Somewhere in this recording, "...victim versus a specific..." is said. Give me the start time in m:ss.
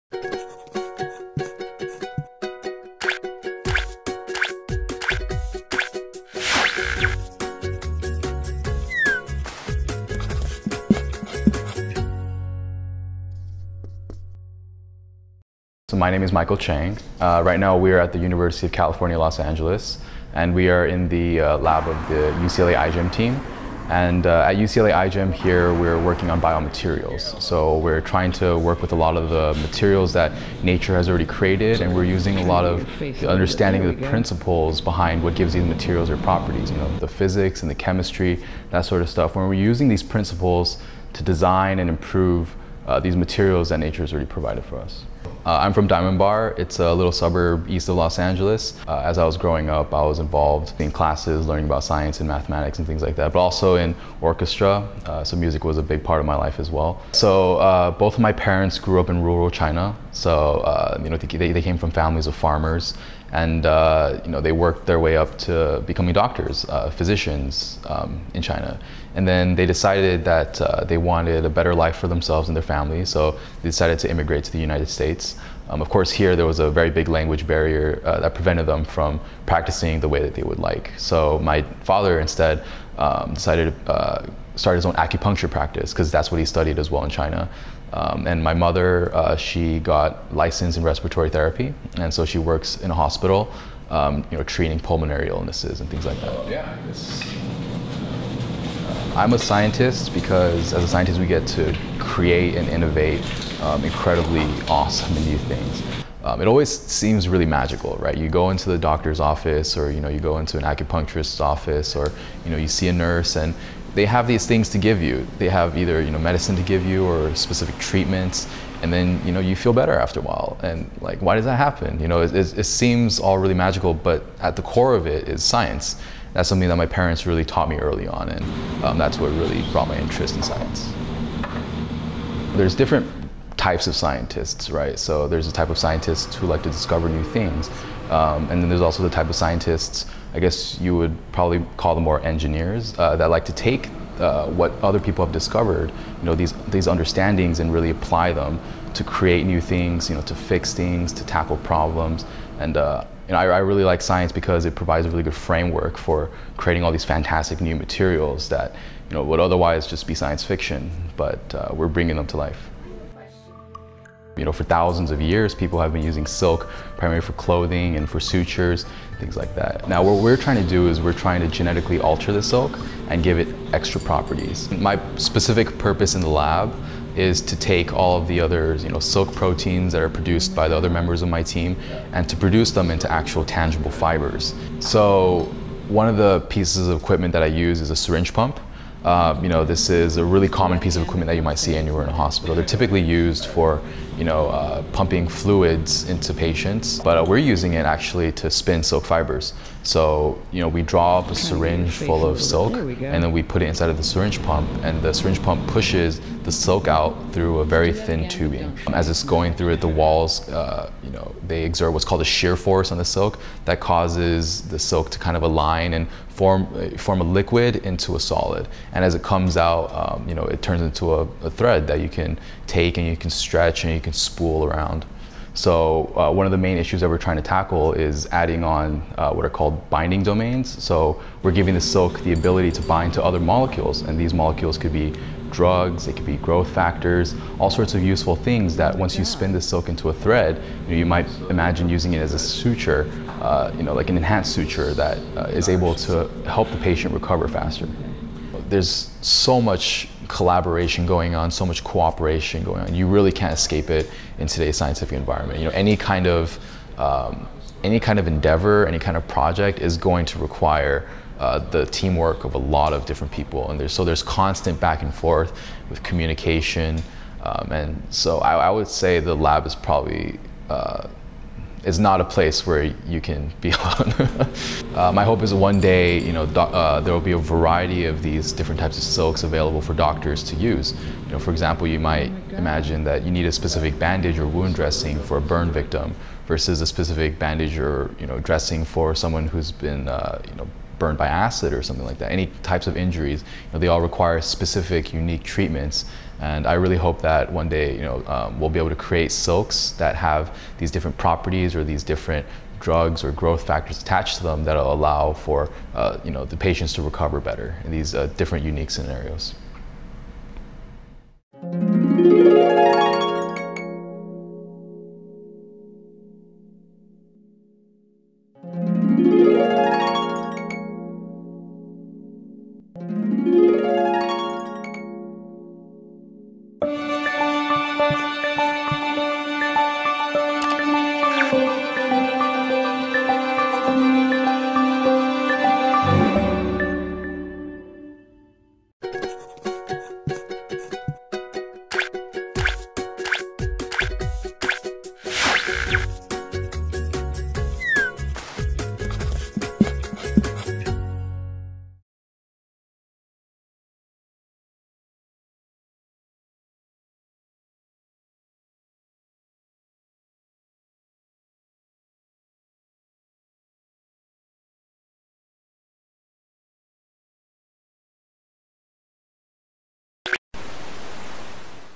4:45.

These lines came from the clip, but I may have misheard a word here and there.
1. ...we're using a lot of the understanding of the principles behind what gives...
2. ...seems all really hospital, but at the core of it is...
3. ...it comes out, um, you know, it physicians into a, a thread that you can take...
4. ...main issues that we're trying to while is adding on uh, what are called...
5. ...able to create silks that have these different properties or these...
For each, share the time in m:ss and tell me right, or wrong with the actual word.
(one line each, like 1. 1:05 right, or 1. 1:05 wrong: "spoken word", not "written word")
1. 0:31 right
2. 2:02 wrong: "magical", not "hospital"
3. 3:39 wrong: "turns", not "physicians"
4. 3:46 wrong: "tackle", not "while"
5. 4:58 right.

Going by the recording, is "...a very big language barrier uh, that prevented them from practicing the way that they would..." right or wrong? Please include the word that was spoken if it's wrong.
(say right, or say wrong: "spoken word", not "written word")
right.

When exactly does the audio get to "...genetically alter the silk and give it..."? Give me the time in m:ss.
2:51.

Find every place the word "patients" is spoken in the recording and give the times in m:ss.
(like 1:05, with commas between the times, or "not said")
3:16, 4:06, 5:06.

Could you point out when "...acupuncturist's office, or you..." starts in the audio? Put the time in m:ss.
1:50.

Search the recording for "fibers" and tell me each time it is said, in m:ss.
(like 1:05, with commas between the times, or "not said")
3:03, 3:19.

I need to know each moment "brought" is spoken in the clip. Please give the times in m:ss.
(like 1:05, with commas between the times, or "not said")
2:09.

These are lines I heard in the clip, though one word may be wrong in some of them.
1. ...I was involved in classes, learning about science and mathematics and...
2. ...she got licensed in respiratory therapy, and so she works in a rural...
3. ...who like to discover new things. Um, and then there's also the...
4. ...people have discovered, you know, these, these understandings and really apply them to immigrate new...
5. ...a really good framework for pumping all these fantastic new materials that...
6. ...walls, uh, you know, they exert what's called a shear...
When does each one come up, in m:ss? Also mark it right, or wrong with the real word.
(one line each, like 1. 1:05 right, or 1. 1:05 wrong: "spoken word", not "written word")
1. 0:49 right
2. 1:29 wrong: "hospital", not "rural"
3. 2:16 right
4. 2:24 wrong: "create", not "immigrate"
5. 2:35 wrong: "creating", not "pumping"
6. 3:29 right.